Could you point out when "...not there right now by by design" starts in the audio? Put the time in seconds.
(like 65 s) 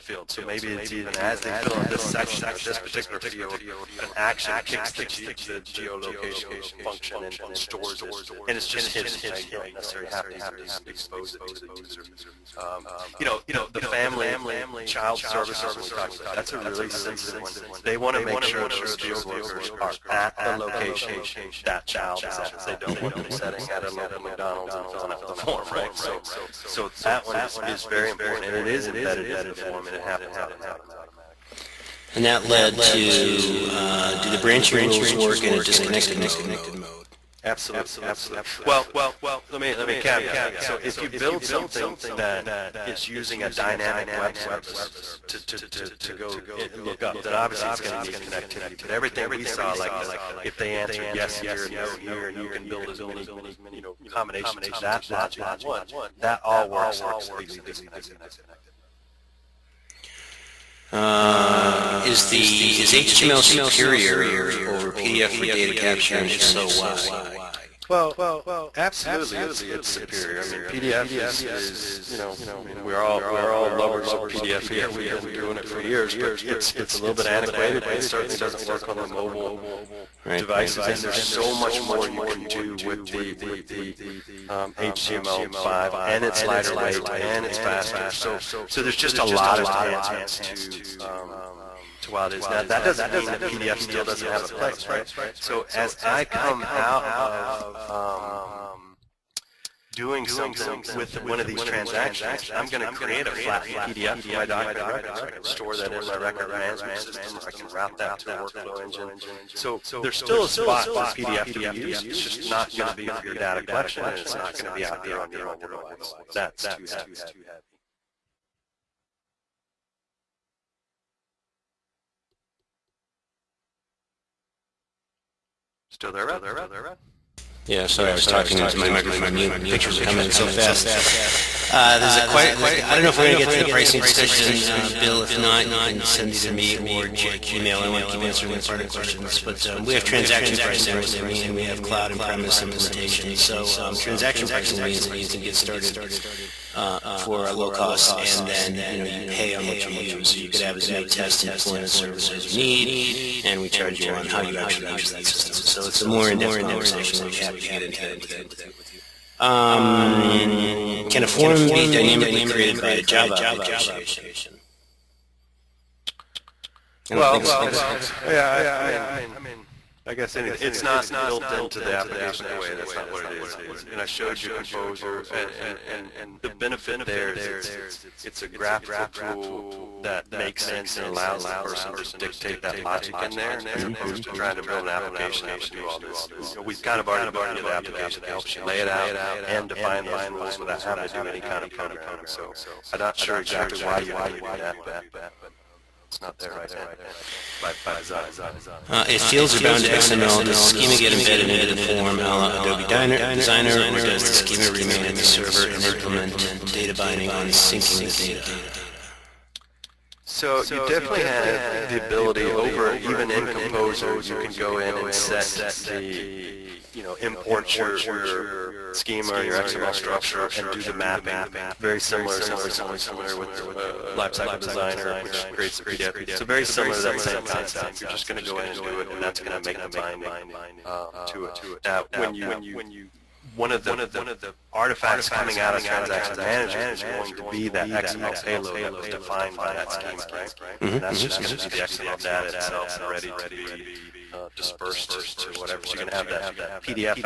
196 s.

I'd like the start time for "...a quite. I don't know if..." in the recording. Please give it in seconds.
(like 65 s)
132 s.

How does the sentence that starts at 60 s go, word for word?
Uh, is the is HTML superior over PDF for data capture, and if so, why?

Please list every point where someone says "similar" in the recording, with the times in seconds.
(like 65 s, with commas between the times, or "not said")
221 s, 226 s.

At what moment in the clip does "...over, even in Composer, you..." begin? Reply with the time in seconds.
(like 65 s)
212 s.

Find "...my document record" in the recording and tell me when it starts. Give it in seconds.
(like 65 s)
104 s.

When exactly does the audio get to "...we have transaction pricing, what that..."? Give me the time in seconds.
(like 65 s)
139 s.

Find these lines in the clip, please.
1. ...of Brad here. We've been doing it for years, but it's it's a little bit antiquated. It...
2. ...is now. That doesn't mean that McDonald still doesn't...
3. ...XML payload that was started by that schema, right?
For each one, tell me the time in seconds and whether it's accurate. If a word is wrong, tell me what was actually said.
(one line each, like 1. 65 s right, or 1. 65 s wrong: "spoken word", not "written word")
1. 74 s wrong: "PDF", not "Brad"
2. 92 s wrong: "PDF", not "McDonald"
3. 237 s wrong: "defined", not "started".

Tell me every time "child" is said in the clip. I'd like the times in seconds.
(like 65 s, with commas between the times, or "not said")
14 s, 21 s.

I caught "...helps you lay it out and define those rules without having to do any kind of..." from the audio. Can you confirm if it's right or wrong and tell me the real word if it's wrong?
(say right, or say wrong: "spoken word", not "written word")
right.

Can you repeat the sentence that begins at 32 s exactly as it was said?
And that led to, uh, do the branching rules work in a disconnected mode?